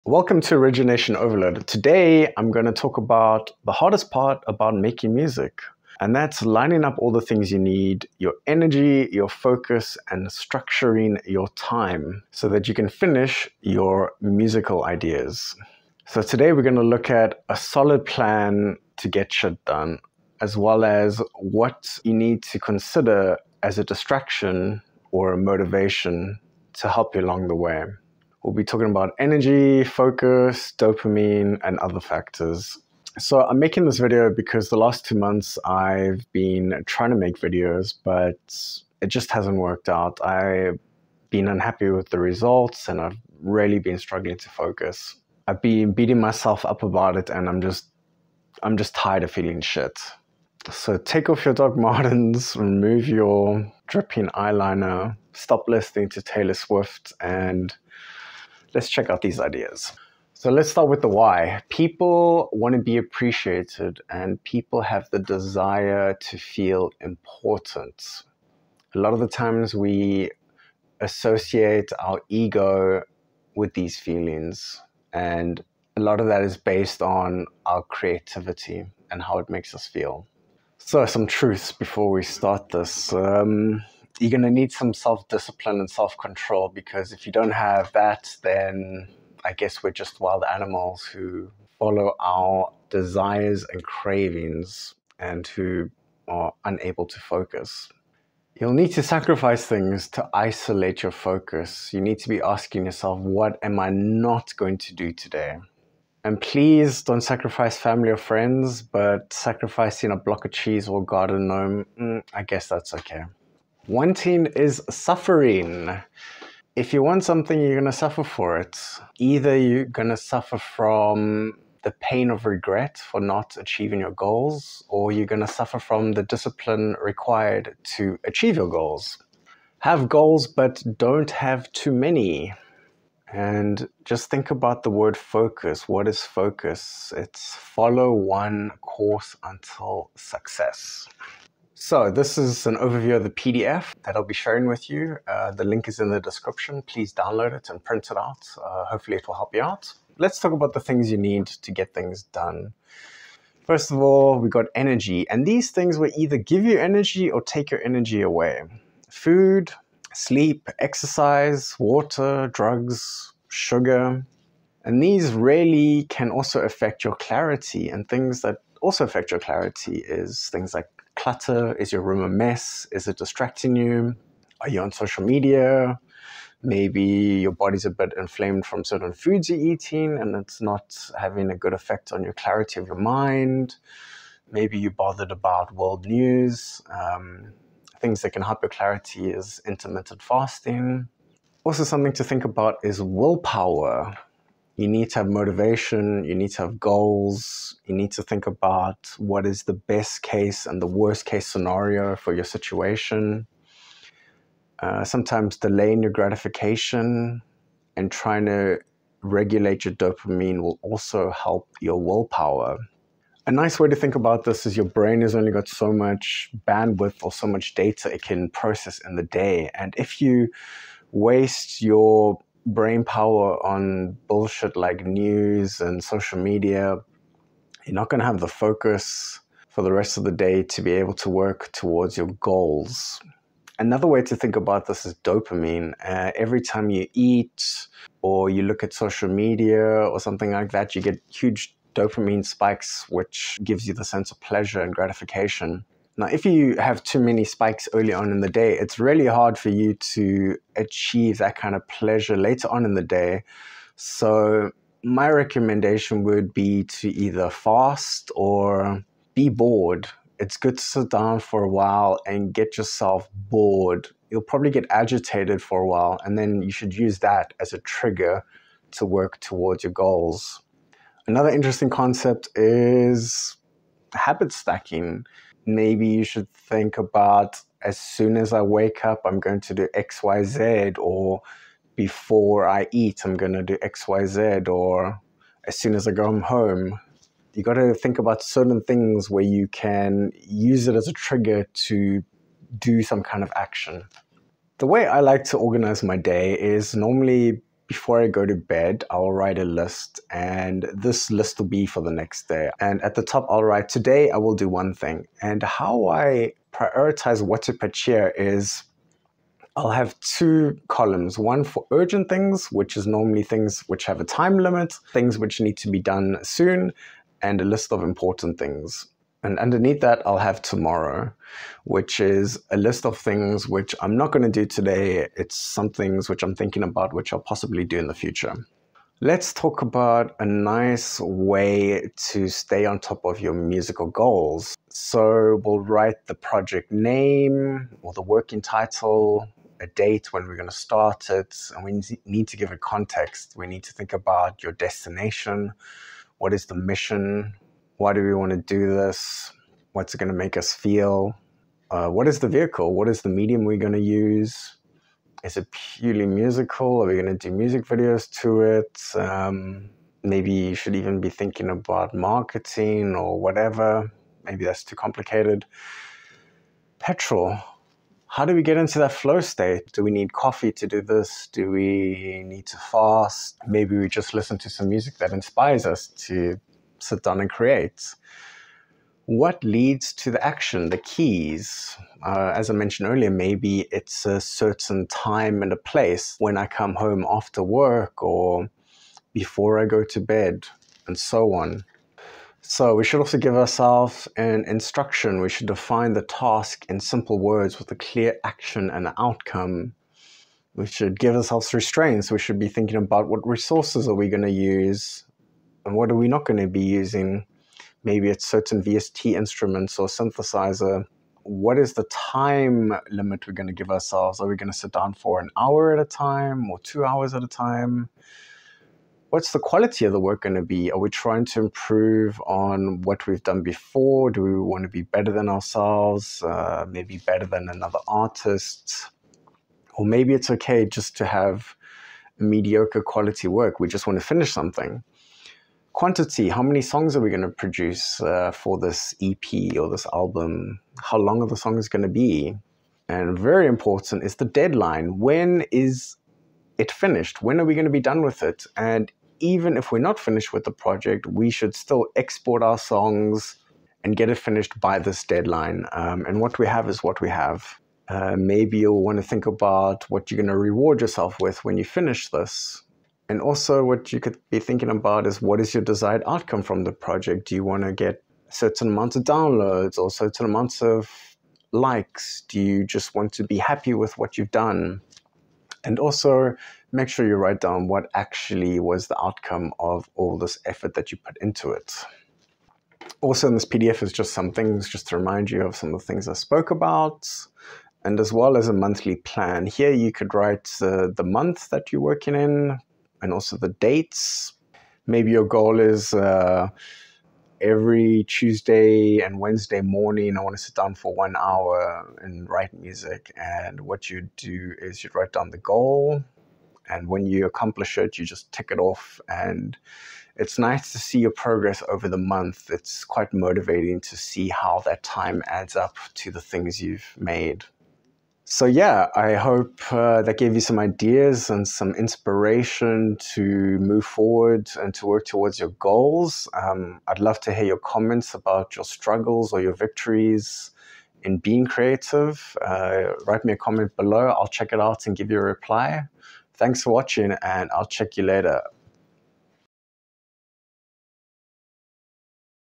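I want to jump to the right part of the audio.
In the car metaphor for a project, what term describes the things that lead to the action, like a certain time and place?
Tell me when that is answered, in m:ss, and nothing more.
6:20.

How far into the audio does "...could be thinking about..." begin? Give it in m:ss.
7:44.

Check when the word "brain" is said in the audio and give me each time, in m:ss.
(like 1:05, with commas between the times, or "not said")
3:34, 3:42.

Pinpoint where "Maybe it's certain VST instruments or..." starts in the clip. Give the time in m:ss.
6:48.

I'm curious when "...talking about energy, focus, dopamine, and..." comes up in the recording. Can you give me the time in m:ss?
0:28.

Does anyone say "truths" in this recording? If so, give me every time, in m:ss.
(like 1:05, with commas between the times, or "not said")
1:21.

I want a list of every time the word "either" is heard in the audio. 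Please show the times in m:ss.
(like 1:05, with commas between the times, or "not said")
1:59, 2:36, 4:17.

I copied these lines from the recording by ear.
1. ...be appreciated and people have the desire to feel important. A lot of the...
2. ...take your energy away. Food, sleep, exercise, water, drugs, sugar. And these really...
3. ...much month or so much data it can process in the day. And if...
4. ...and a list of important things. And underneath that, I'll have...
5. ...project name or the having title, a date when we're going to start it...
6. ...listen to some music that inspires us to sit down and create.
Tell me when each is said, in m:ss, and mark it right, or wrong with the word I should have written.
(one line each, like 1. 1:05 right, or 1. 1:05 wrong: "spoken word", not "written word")
1. 1:02 right
2. 2:37 right
3. 3:35 wrong: "bandwidth", not "month"
4. 5:17 right
5. 5:36 wrong: "working", not "having"
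6. 6:14 right.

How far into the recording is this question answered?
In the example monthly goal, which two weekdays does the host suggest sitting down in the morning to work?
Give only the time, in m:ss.
8:18.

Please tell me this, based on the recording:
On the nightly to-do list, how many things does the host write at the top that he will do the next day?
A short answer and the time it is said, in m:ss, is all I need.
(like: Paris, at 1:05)
1, at 5:04.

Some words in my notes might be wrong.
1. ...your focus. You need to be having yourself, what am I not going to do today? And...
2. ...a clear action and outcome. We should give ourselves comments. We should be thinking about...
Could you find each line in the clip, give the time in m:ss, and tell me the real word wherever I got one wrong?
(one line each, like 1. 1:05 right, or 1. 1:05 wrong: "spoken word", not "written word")
1. 1:41 wrong: "asking", not "having"
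2. 6:37 wrong: "restraints", not "comments".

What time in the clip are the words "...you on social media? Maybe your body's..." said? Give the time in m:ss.
2:54.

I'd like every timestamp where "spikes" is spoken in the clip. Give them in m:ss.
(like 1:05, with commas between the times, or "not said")
4:02, 4:07.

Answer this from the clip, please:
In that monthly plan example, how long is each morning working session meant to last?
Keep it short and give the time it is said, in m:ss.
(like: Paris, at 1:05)
1 hour, at 8:21.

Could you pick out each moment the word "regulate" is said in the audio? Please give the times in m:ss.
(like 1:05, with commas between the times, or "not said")
3:29.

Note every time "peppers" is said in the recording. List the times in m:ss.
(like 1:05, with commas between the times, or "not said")
not said.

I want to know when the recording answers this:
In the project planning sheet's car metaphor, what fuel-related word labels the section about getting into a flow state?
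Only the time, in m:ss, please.
6:06.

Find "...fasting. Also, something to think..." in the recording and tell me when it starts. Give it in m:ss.
3:10.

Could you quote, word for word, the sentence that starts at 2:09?
Have goals, but don't have too many.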